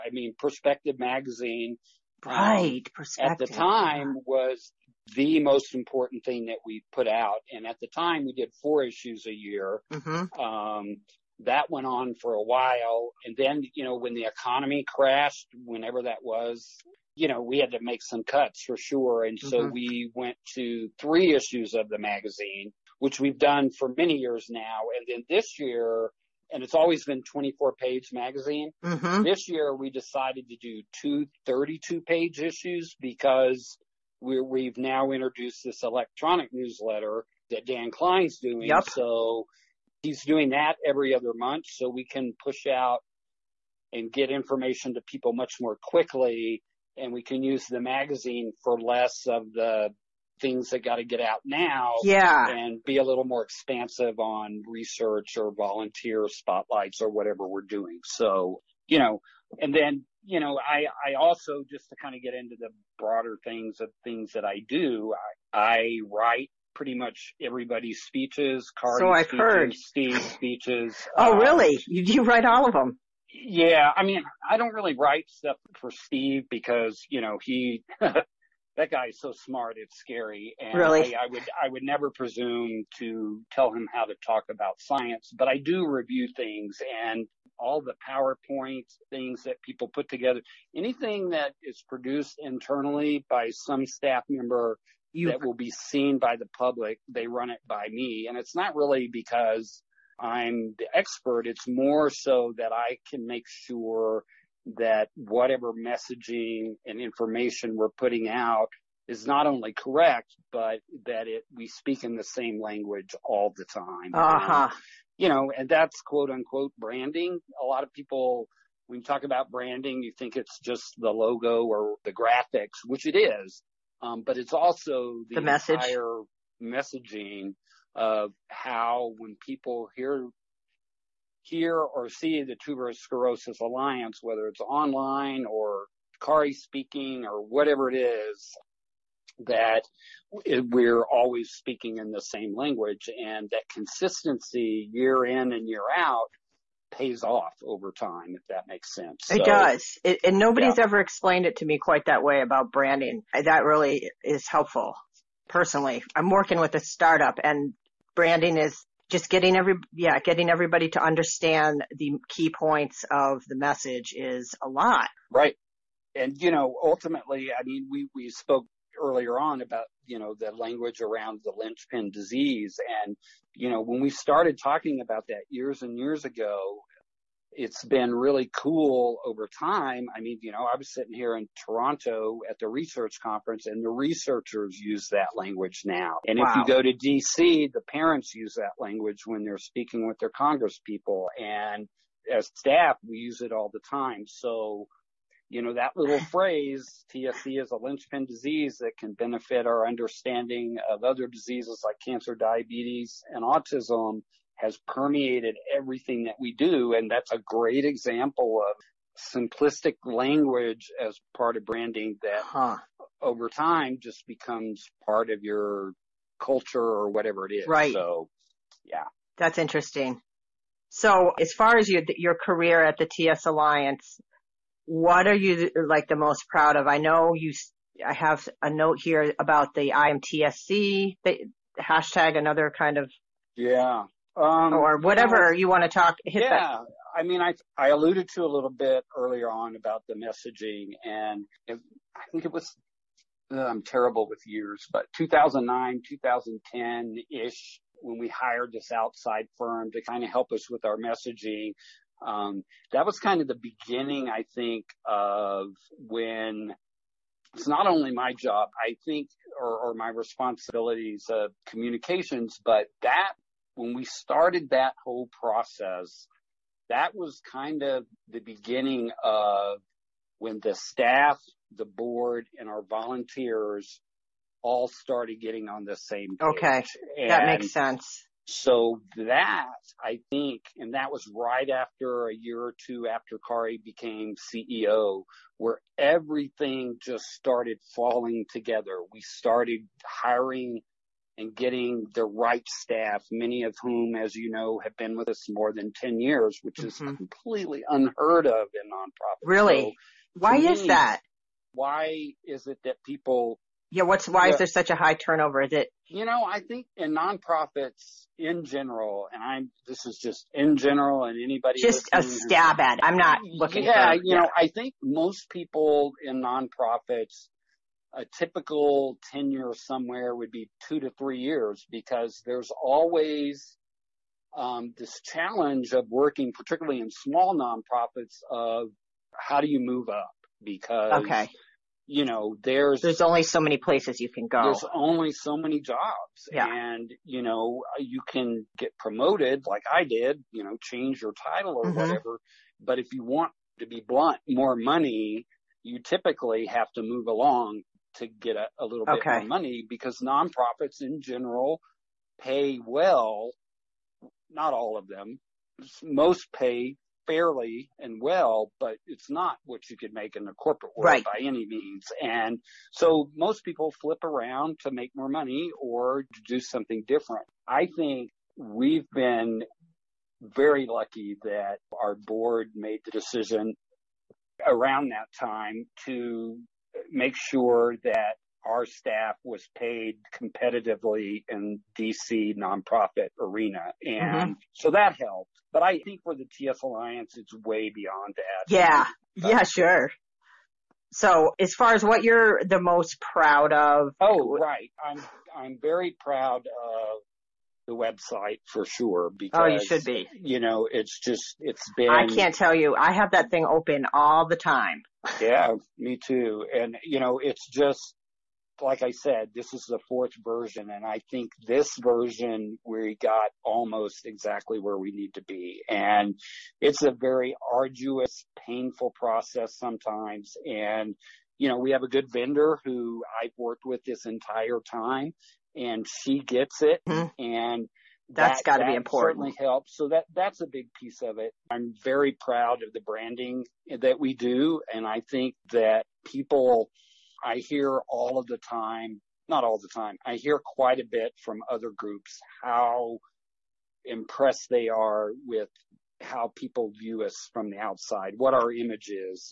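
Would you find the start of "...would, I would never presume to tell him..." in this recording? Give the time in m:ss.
1:21.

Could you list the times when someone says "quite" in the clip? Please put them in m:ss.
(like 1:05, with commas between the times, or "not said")
2:31, 7:20.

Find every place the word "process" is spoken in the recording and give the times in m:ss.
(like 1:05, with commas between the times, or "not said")
4:25, 6:59.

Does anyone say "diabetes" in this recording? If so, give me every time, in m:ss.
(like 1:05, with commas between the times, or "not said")
3:22.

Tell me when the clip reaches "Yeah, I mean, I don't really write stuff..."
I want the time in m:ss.
1:13.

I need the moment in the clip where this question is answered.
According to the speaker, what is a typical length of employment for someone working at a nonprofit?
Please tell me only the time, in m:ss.
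5:20.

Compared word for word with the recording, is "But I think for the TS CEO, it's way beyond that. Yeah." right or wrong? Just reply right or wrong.
wrong.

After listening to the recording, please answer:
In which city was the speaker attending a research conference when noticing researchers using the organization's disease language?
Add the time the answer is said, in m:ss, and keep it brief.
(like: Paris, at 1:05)
Toronto, at 3:01.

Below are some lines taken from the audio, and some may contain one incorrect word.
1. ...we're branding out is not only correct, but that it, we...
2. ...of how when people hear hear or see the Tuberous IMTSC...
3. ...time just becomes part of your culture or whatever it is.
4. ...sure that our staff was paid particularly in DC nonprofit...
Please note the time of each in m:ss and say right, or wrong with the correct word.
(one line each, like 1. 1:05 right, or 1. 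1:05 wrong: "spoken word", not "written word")
1. 1:47 wrong: "putting", not "branding"
2. 2:07 wrong: "Sclerosis", not "IMTSC"
3. 3:33 right
4. 6:17 wrong: "competitively", not "particularly".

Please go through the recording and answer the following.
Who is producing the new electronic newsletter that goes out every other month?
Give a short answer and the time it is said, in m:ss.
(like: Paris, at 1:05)
Dan Klein, at 0:37.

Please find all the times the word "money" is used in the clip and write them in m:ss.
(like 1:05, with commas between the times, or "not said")
5:44, 5:49, 6:05.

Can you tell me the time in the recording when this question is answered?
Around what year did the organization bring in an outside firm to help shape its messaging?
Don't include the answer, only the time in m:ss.
4:05.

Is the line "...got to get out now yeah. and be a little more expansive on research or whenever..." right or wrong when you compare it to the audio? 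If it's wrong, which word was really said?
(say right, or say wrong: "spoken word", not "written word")
wrong: "volunteer", not "whenever".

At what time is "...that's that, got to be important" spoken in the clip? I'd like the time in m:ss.
7:08.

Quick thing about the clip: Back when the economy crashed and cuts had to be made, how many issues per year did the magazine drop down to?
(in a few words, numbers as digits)
3.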